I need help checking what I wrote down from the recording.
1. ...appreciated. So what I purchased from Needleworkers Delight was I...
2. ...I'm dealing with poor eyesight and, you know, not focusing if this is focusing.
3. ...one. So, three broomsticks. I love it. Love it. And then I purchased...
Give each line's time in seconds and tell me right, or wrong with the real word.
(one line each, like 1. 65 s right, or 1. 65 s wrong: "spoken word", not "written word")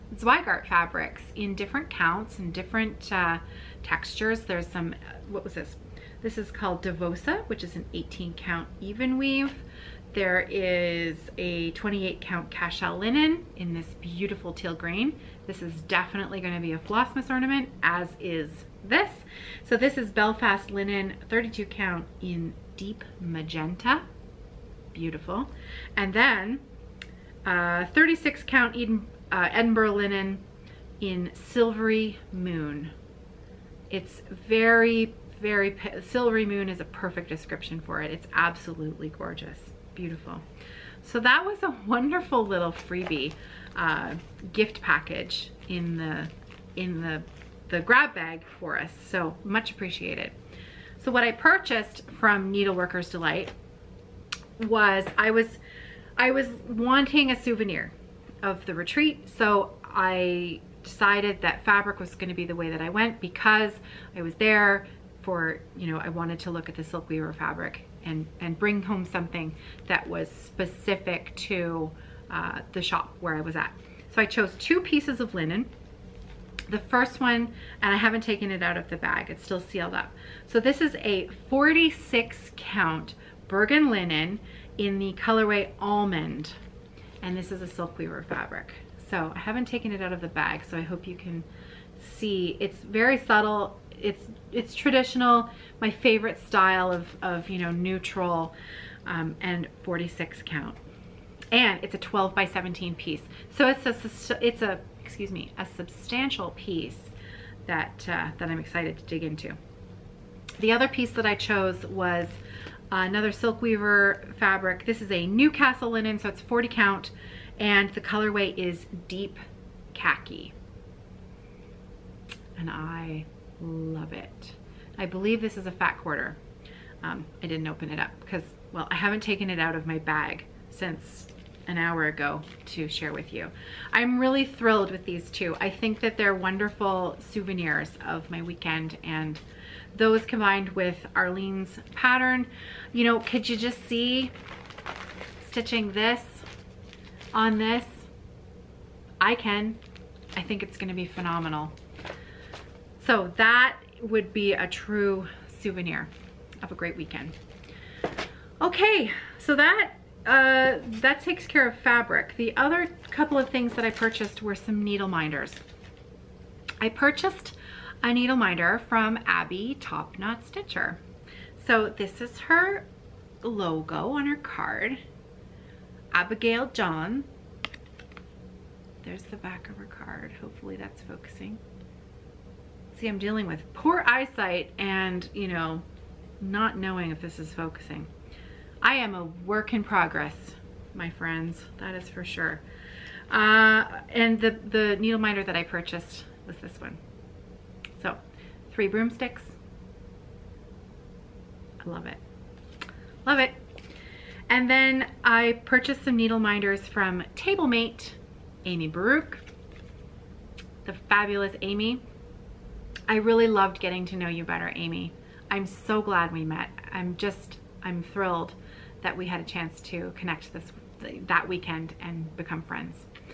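1. 49 s right
2. 183 s wrong: "knowing", not "focusing"
3. 196 s right.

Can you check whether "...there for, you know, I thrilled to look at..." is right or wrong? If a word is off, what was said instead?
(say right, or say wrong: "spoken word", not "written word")
wrong: "wanted", not "thrilled".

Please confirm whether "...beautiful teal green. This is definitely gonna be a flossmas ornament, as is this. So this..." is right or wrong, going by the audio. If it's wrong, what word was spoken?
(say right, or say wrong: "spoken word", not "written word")
right.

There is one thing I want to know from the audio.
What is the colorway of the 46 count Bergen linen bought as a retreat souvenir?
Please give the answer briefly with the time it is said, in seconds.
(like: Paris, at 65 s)
almond, at 85 s.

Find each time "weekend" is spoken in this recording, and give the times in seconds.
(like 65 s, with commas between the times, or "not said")
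138 s, 156 s, 221 s.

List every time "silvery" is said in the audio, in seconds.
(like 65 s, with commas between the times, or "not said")
31 s, 36 s.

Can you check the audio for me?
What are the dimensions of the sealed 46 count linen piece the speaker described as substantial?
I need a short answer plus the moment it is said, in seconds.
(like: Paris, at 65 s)
12 by 17, at 101 s.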